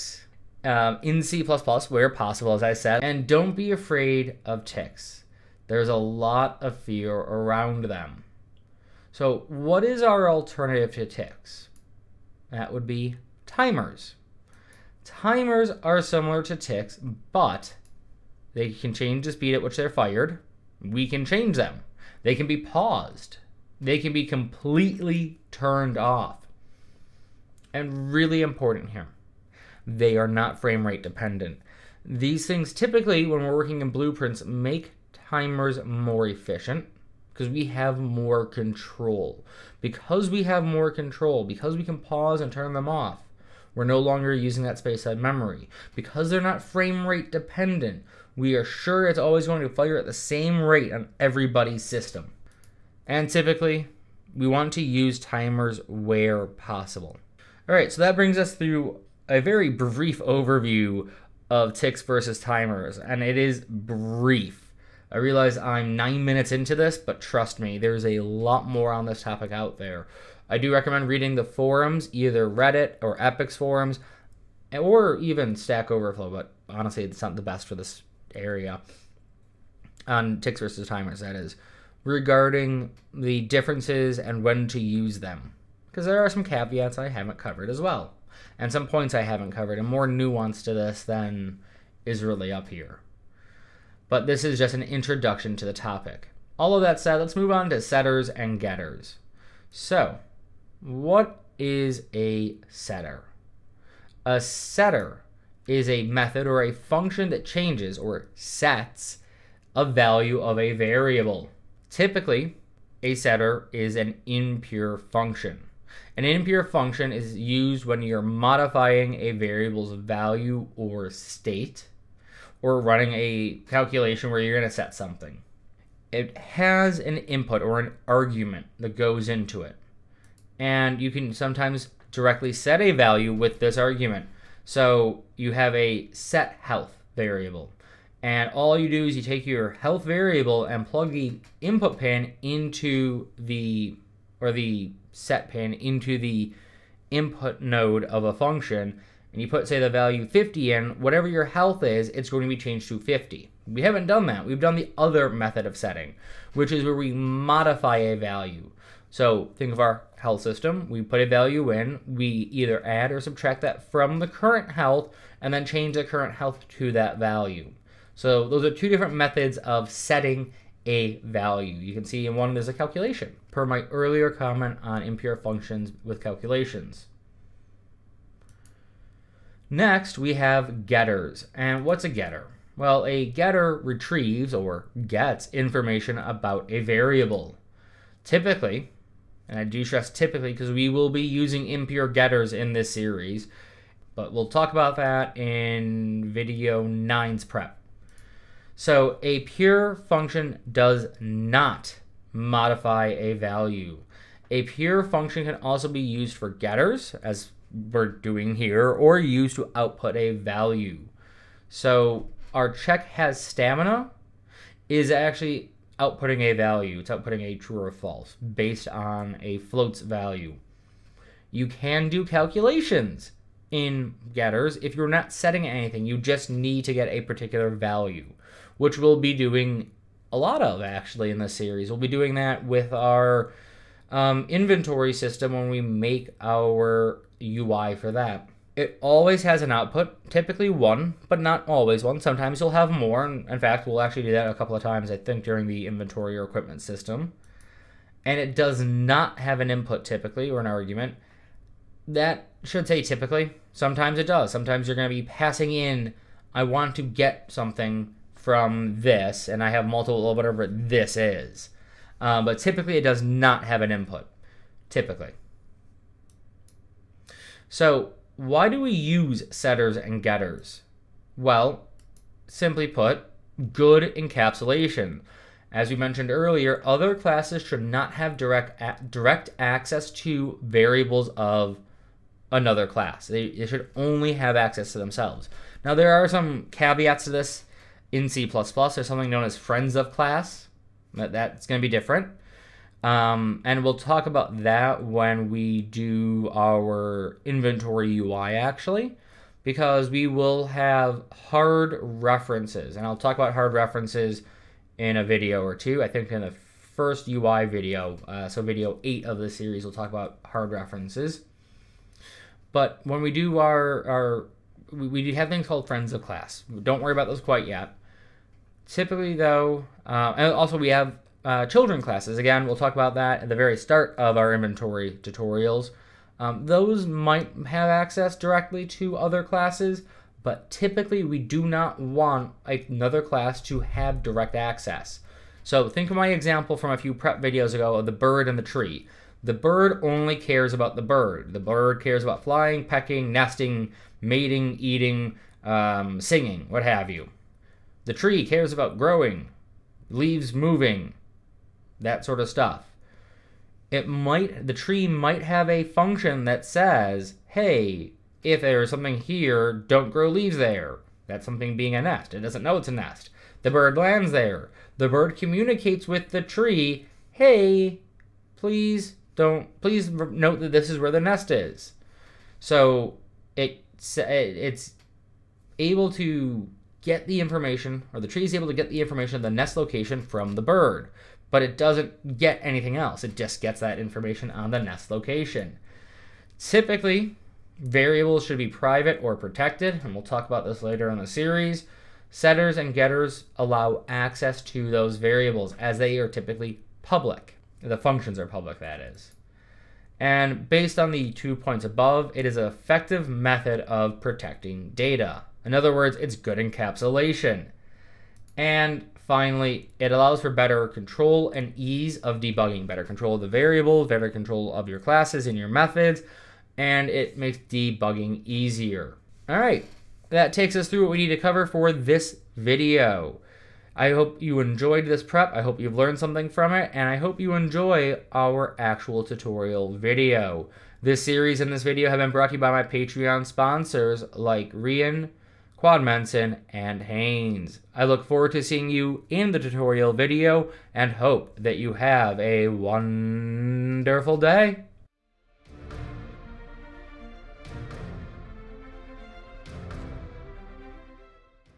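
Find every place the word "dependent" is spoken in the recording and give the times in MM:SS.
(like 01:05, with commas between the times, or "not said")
00:31, 00:47.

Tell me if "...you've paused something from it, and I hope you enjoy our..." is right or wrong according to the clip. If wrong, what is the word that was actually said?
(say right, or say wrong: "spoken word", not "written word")
wrong: "learned", not "paused".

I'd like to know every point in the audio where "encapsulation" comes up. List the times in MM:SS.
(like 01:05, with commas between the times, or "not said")
04:34, 06:46.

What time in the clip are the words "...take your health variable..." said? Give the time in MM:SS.
02:19.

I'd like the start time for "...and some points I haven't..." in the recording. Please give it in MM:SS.
01:28.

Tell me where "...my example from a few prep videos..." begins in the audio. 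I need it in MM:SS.
05:36.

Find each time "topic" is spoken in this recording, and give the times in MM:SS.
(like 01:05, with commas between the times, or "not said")
01:09, 01:35.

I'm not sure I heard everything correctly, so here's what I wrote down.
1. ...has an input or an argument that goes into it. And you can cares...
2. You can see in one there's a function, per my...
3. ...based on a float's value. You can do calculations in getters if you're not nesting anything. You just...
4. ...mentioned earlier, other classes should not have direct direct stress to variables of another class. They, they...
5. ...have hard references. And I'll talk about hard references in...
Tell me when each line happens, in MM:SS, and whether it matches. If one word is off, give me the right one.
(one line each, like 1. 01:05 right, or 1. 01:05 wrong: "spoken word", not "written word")
1. 02:06 wrong: "sometimes", not "cares"
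2. 02:51 wrong: "calculation", not "function"
3. 03:38 wrong: "setting", not "nesting"
4. 04:35 wrong: "access", not "stress"
5. 05:00 right.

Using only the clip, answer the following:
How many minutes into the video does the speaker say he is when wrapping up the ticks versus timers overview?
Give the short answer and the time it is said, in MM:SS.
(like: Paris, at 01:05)
9, at 01:05.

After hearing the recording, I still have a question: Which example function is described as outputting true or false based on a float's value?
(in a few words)
check has stamina.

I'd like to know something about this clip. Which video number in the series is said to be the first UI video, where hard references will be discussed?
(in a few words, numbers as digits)
8.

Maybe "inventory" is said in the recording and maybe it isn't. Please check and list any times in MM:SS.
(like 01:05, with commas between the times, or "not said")
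03:54, 04:05, 04:57, 05:24.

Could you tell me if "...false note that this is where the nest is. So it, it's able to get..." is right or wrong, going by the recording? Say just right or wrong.
wrong.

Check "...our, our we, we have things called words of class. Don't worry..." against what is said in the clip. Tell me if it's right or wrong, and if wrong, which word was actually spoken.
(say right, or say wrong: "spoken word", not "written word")
wrong: "friends", not "words".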